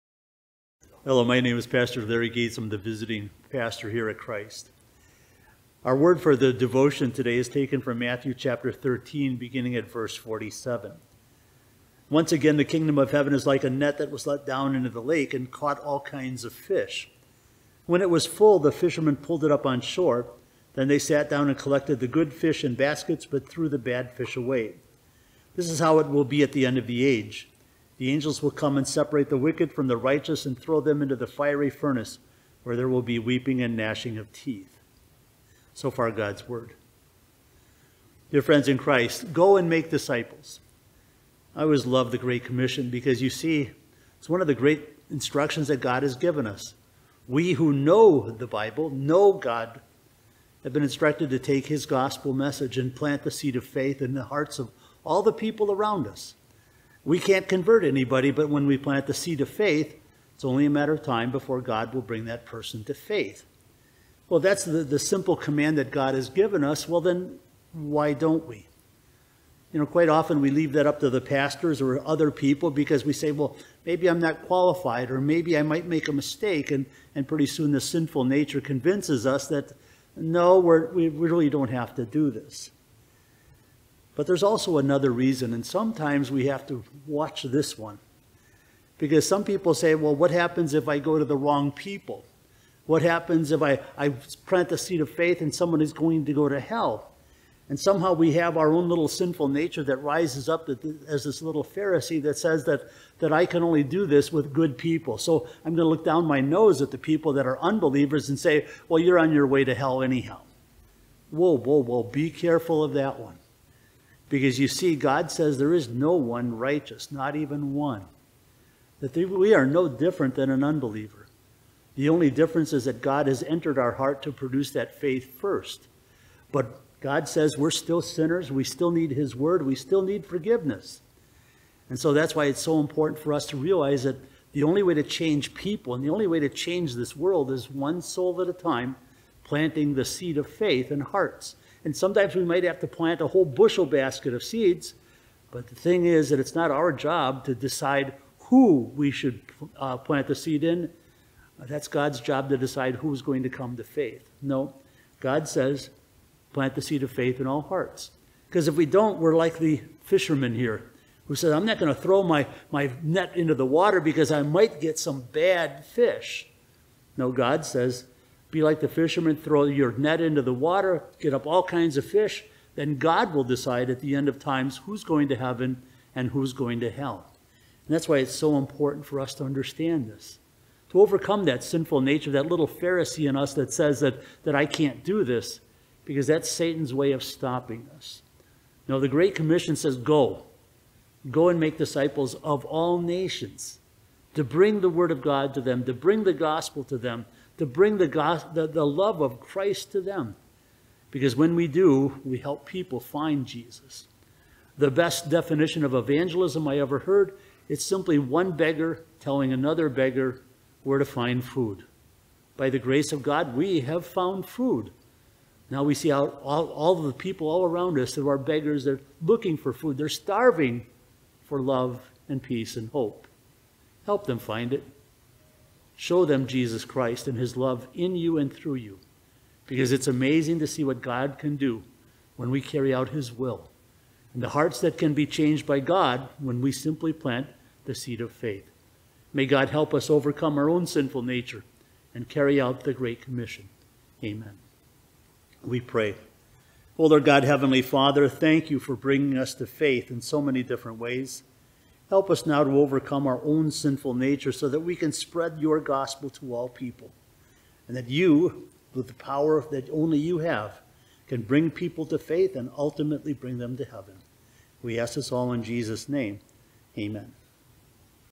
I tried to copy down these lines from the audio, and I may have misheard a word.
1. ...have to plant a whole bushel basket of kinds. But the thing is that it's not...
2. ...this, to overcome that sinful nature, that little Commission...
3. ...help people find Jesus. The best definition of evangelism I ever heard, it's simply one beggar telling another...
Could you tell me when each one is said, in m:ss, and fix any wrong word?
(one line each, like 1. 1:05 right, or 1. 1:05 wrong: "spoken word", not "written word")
1. 2:22 wrong: "seeds", not "kinds"
2. 3:00 wrong: "Pharisee", not "Commission"
3. 3:22 right.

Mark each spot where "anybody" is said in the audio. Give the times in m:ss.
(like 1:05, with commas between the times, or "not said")
0:57.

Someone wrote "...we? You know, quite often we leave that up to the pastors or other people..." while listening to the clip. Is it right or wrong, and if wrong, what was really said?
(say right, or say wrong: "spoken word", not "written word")
right.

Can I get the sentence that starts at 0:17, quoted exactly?
When it was full, the fishermen pulled it up on shore.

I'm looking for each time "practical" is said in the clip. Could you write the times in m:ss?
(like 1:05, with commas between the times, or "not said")
not said.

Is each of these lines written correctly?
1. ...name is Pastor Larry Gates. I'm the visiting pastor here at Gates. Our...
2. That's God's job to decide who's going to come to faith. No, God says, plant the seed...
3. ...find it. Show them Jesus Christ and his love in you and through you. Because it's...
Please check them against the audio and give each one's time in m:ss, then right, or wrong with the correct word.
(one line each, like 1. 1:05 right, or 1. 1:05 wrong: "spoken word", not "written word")
1. 0:01 wrong: "Christ", not "Gates"
2. 2:31 right
3. 3:44 right.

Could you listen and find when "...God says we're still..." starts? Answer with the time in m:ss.
2:07.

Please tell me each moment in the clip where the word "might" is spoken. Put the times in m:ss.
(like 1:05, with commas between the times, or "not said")
1:15, 2:22, 2:44.